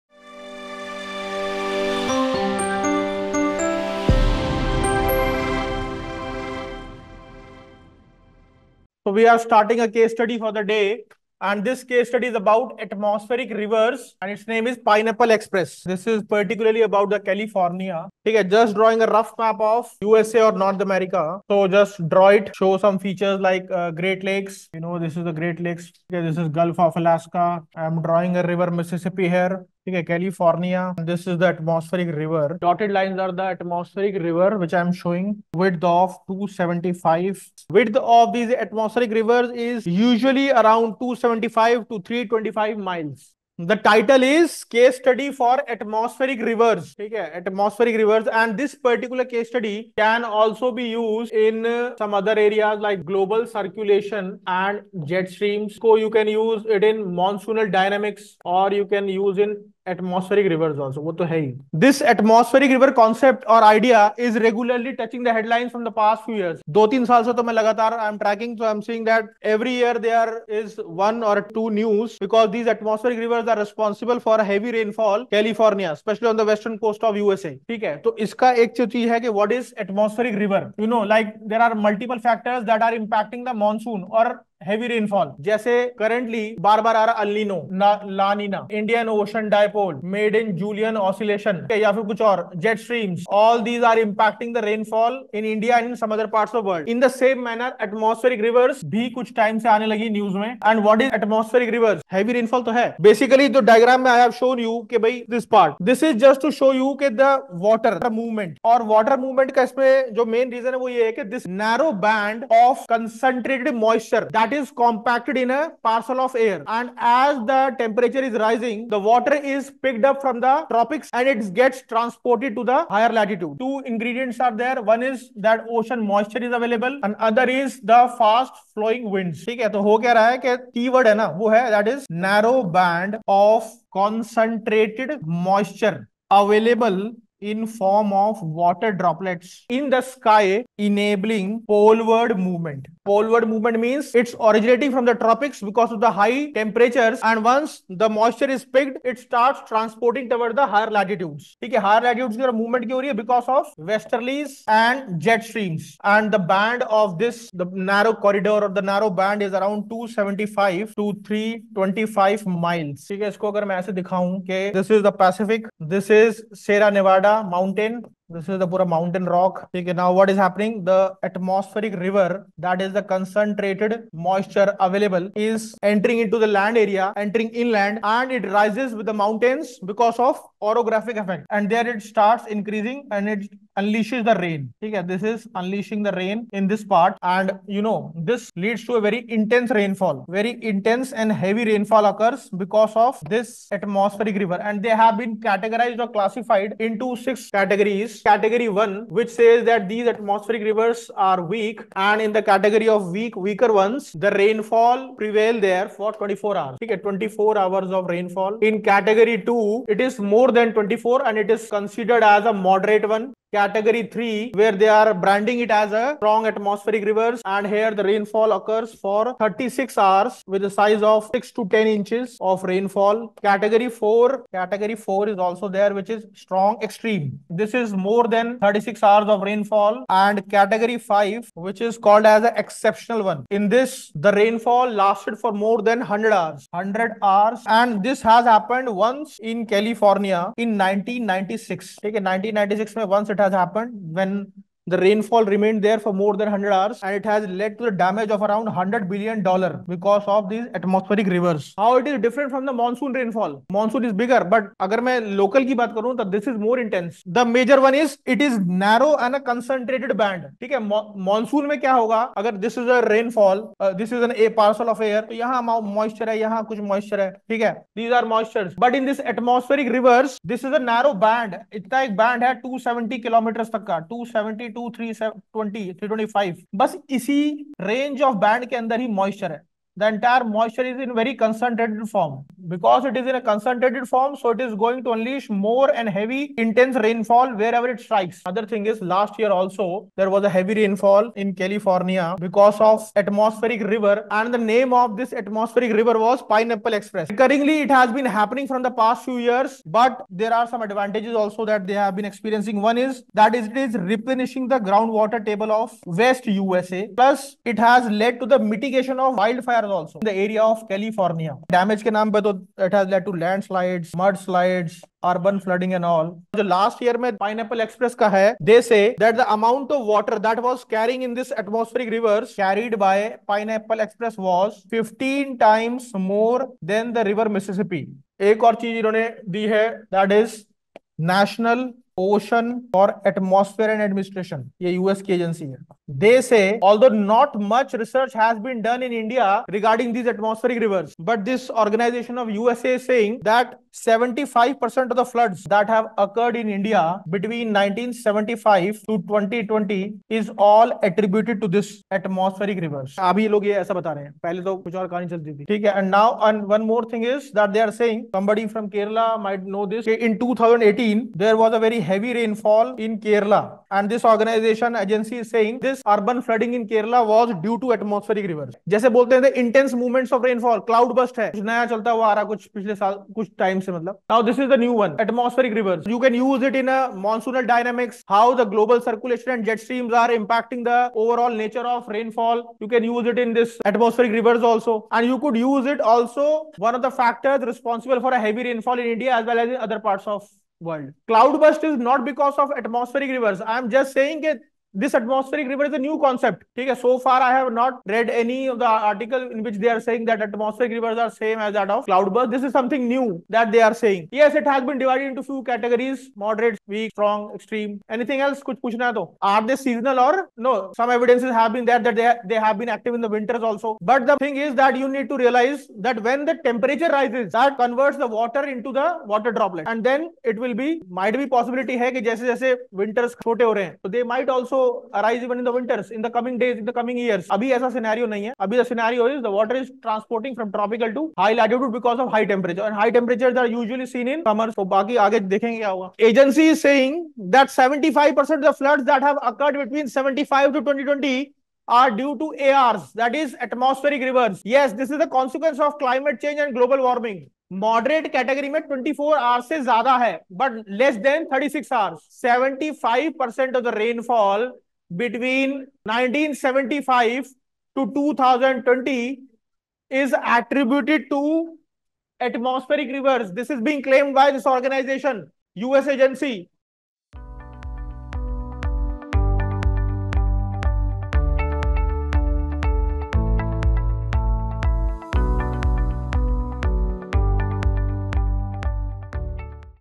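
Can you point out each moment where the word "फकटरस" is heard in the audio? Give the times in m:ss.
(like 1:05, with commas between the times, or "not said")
1:22, 6:27.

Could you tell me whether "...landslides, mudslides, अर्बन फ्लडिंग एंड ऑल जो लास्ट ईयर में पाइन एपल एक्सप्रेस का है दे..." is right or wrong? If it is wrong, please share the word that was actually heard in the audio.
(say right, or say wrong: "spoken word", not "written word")
right.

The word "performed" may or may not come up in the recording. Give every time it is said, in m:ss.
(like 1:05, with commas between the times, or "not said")
not said.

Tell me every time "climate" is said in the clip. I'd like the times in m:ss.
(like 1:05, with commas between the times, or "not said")
7:26.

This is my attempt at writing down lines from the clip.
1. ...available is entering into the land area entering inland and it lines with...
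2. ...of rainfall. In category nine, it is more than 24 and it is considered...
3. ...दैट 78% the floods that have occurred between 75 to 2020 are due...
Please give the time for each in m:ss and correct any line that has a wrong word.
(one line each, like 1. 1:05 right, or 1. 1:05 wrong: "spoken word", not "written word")
1. 2:54 wrong: "rises", not "lines"
2. 3:27 wrong: "two", not "nine"
3. 7:17 wrong: "75", not "78".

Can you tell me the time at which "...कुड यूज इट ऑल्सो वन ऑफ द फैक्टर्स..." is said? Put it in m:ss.
6:25.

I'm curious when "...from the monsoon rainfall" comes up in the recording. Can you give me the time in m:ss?
4:12.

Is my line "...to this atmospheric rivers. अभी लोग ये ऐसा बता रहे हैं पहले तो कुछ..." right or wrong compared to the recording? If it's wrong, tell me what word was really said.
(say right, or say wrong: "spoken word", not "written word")
right.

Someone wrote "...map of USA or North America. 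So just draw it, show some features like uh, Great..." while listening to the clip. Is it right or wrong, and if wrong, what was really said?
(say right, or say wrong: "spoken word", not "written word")
right.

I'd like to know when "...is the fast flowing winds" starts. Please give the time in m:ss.
2:07.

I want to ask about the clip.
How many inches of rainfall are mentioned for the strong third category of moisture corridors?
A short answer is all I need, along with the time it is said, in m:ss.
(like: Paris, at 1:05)
6 to 10 inches, at 3:41.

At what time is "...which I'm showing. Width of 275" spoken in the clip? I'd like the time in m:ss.
0:34.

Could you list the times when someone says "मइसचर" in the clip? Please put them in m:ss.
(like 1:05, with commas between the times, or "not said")
1:53, 4:39.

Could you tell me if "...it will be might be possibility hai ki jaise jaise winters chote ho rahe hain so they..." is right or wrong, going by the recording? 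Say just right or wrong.
right.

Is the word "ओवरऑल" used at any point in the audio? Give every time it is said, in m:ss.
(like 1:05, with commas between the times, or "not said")
6:21.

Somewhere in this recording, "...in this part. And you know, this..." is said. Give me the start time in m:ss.
3:06.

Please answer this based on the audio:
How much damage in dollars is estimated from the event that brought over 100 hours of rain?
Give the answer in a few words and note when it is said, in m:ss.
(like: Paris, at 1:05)
100 billion dollars, at 4:08.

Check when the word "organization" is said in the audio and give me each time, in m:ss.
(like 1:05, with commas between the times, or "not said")
5:41, 6:04.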